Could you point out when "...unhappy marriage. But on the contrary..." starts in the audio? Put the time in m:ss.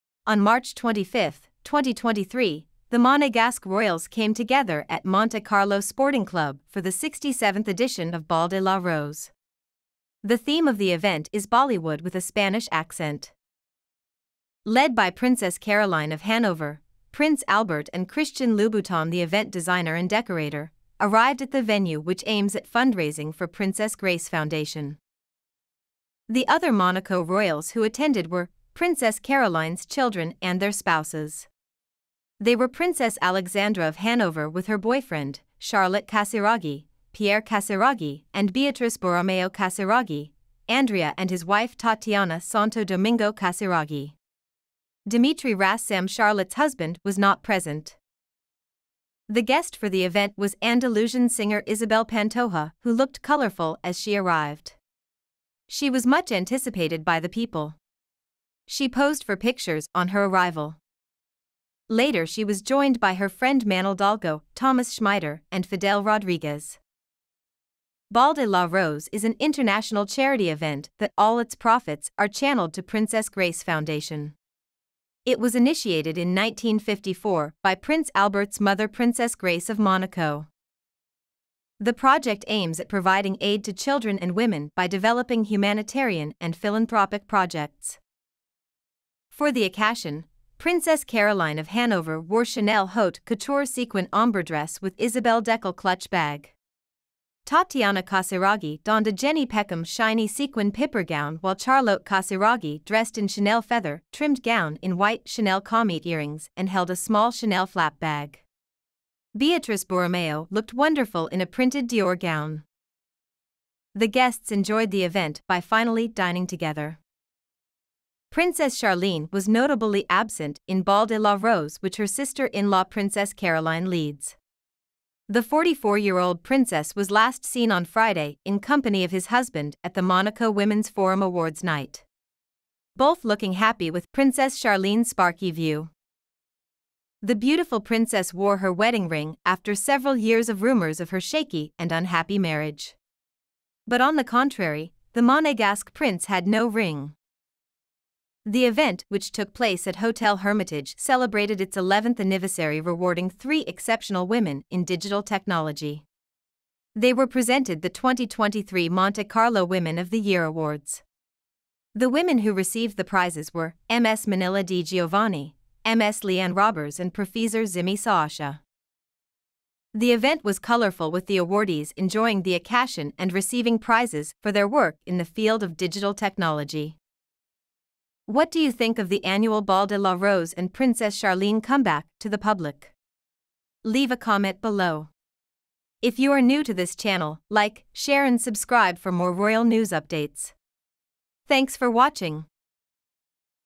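2:21.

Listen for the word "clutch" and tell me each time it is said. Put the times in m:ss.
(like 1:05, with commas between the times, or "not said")
1:35.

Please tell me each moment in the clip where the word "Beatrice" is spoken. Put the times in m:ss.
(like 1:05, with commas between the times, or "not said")
0:38, 1:49.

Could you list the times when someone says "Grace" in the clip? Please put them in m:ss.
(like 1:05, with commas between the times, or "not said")
0:23, 1:13, 1:19.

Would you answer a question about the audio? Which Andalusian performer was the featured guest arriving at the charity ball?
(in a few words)
Isabel Pantoja.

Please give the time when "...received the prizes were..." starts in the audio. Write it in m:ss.
2:42.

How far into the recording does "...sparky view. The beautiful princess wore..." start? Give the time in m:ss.
2:15.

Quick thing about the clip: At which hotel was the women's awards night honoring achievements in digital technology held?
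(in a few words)
Hotel Hermitage.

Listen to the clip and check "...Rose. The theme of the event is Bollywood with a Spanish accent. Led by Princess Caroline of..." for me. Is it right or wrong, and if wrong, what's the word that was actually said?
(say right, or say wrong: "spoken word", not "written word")
right.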